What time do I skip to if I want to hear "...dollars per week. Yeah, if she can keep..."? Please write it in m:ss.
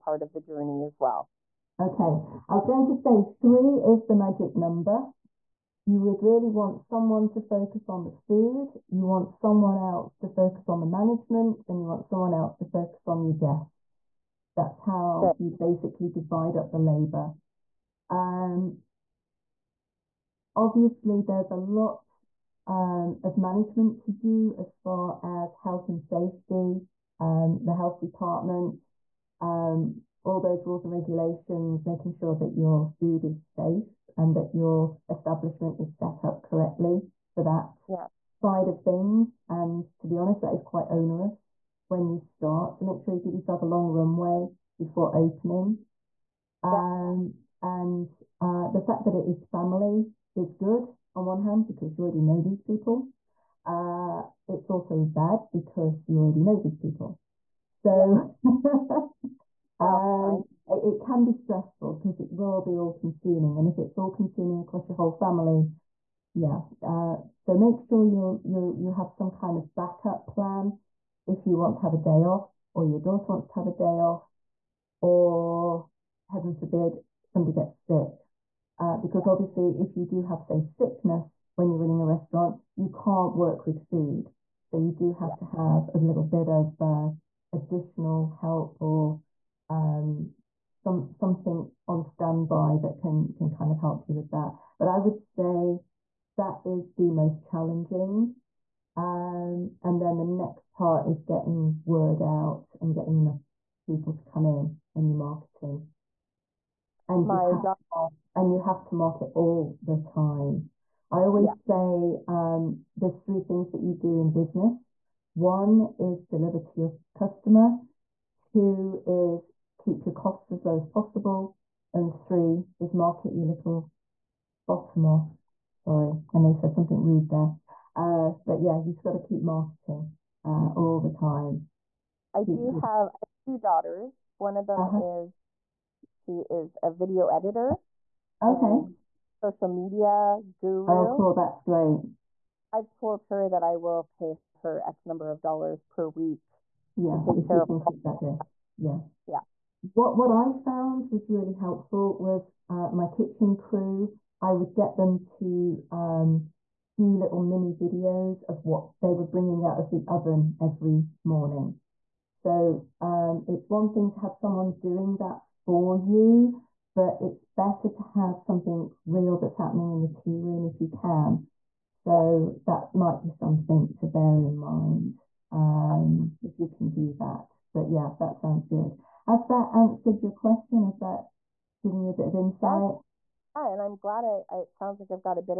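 2:25.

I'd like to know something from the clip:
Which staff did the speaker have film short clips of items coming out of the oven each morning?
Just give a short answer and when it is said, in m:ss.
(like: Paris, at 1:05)
kitchen crew, at 2:33.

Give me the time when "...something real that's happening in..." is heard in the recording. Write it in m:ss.
2:48.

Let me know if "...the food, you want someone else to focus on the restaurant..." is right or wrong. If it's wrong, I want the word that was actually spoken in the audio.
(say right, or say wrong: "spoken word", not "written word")
wrong: "management", not "restaurant".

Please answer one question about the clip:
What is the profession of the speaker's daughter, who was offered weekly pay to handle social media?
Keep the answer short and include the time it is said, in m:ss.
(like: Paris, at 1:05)
video editor, at 2:16.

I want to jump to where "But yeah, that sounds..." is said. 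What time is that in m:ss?
2:57.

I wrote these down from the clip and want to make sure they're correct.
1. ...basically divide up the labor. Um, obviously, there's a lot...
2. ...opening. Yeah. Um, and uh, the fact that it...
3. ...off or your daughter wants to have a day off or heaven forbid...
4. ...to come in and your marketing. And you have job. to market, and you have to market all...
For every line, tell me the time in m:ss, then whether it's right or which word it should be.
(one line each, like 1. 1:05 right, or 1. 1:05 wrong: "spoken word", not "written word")
1. 0:15 right
2. 0:45 right
3. 1:12 right
4. 1:44 right.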